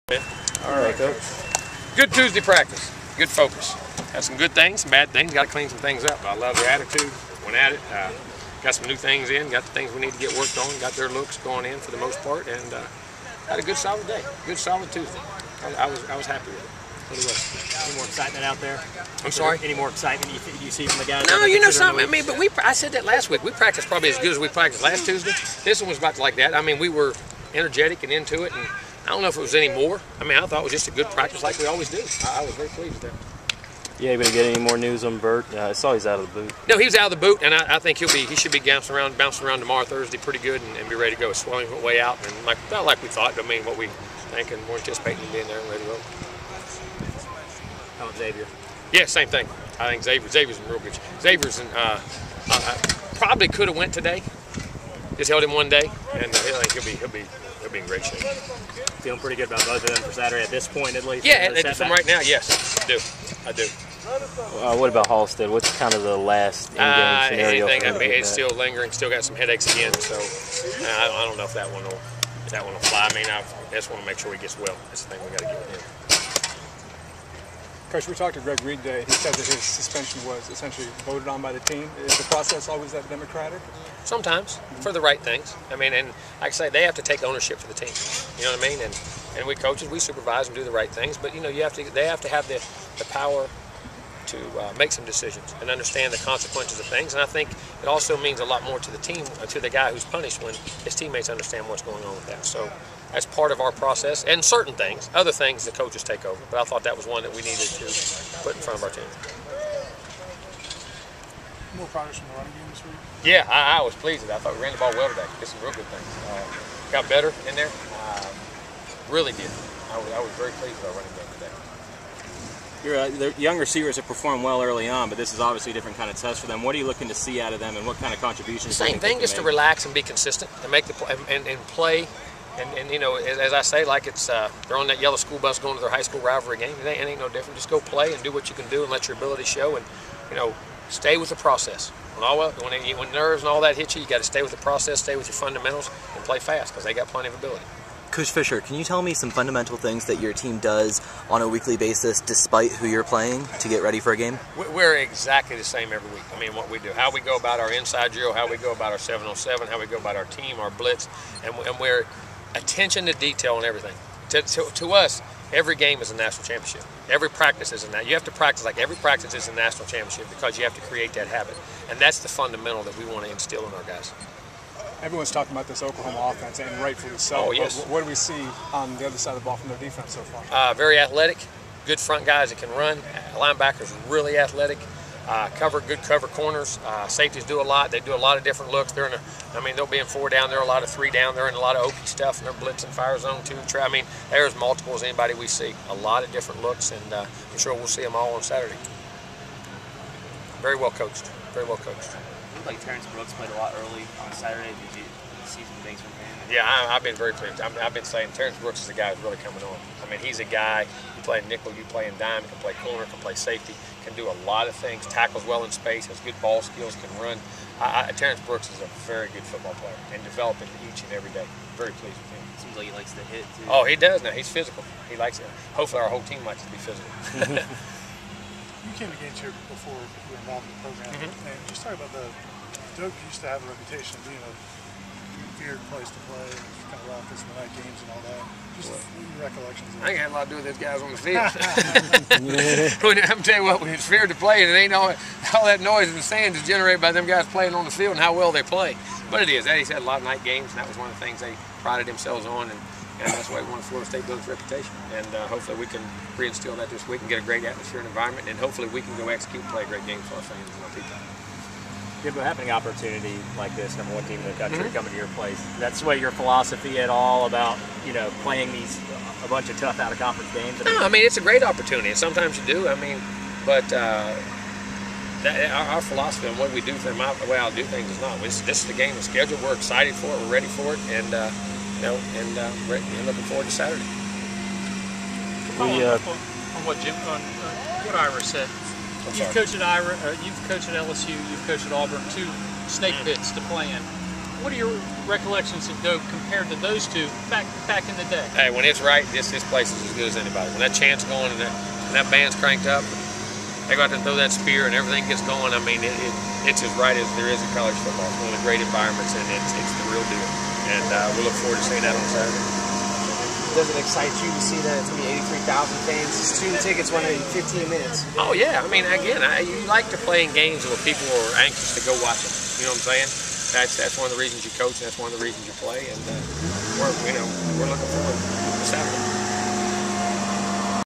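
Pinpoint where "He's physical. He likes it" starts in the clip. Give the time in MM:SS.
03:44.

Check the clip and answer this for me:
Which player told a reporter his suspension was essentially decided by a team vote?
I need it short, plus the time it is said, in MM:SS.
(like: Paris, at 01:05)
Greg Reed, at 01:18.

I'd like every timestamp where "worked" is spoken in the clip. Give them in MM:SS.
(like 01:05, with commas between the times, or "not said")
00:10.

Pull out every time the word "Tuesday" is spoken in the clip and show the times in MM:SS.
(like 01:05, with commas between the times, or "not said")
00:02, 00:14, 00:25.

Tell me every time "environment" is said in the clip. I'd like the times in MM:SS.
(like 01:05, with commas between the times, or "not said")
04:18, 05:08.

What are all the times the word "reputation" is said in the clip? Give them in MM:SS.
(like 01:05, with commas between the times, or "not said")
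03:53, 04:14.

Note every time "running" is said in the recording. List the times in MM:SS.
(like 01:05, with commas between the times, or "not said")
01:52, 02:00.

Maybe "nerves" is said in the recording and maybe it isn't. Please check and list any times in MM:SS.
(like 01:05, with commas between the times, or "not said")
02:23.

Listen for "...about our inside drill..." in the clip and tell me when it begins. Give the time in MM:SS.
02:37.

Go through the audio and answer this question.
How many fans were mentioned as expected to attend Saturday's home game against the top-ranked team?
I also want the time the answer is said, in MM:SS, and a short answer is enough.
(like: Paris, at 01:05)
83,000, at 05:15.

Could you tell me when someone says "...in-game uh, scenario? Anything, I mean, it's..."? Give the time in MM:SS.
01:06.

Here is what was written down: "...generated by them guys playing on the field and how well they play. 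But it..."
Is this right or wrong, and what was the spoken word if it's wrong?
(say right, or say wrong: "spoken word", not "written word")
right.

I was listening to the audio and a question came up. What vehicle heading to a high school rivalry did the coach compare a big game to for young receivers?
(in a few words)
yellow school bus.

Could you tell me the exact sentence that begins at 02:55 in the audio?
Everyone's talking about this Oklahoma offense, and rightfully so.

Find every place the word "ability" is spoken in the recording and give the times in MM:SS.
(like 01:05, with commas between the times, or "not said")
02:19, 02:27.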